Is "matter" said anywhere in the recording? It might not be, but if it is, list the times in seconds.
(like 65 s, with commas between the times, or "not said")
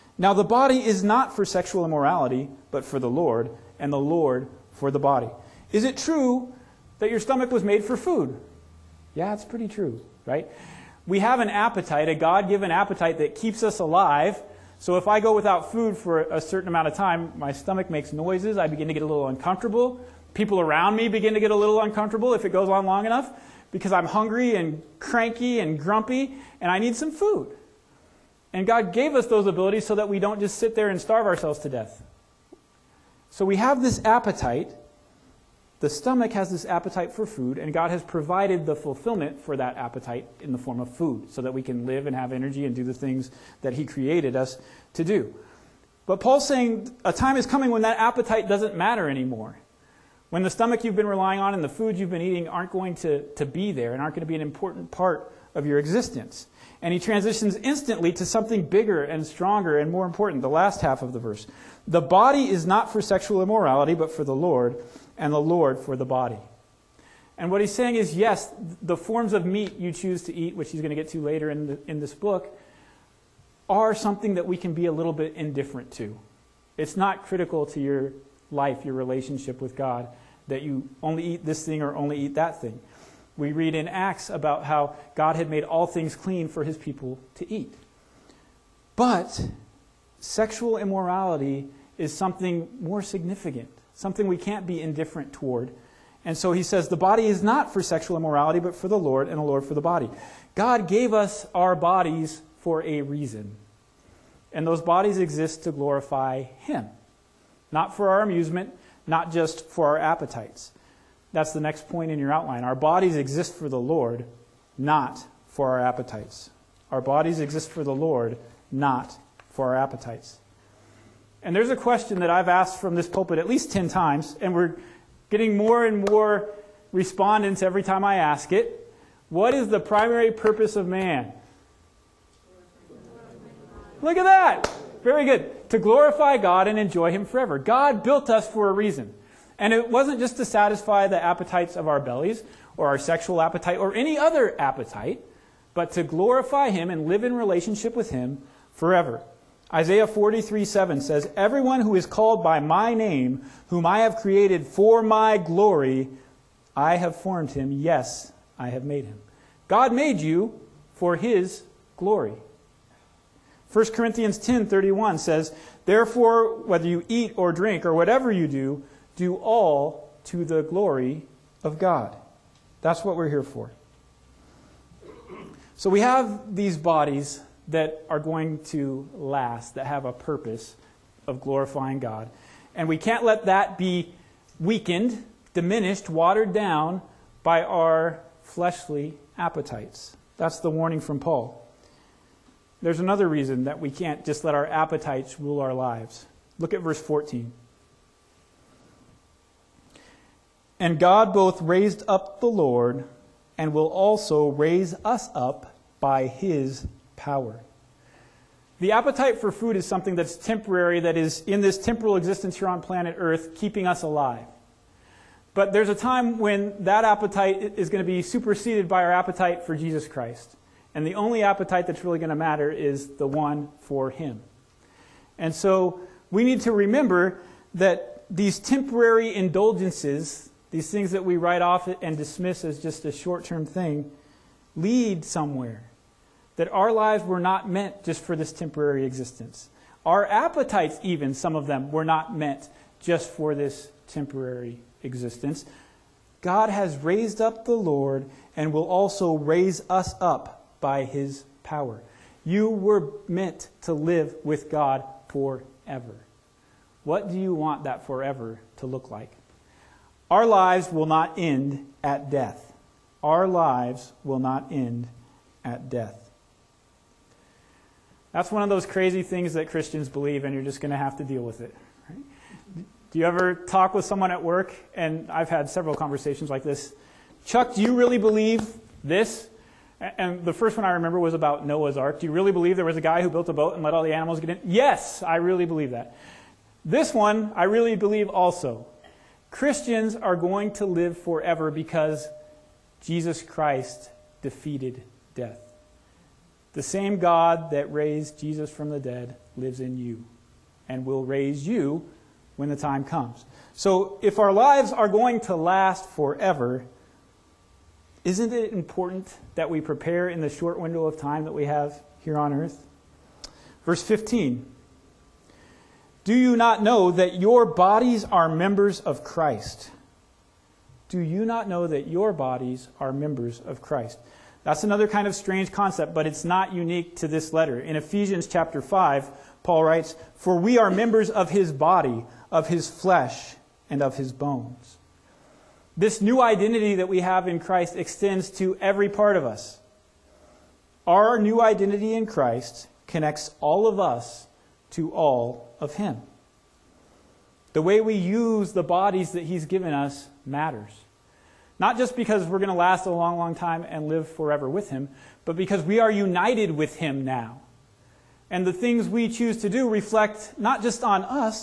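48 s, 222 s, 350 s.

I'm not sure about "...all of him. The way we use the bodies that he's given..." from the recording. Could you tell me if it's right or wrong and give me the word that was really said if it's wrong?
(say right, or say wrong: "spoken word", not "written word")
right.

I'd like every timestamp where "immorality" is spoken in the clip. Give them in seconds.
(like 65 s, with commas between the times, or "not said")
1 s, 63 s, 90 s, 98 s.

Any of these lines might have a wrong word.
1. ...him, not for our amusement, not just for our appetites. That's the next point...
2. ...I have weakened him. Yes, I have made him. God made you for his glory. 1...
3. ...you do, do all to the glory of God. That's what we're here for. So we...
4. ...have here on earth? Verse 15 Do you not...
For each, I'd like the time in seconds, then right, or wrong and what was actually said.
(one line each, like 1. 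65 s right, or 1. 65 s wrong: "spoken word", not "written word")
1. 106 s right
2. 156 s wrong: "formed", not "weakened"
3. 168 s right
4. 311 s right.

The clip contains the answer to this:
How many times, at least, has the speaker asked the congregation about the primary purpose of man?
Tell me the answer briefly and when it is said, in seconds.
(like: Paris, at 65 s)
10, at 123 s.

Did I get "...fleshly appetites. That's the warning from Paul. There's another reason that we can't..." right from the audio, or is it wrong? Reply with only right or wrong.
right.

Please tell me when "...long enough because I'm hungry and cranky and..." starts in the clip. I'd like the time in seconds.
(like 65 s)
22 s.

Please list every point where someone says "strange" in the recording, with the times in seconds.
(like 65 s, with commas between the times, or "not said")
325 s.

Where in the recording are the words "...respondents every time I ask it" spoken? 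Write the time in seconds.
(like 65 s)
126 s.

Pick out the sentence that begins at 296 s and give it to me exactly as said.
The same God that raised Jesus from the dead lives in you and will raise you when the time comes.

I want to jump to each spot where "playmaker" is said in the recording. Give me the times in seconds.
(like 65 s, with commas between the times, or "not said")
not said.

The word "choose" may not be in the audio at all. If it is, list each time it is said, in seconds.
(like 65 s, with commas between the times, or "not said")
69 s, 359 s.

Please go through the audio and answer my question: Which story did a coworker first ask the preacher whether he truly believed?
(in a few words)
Noah's Ark.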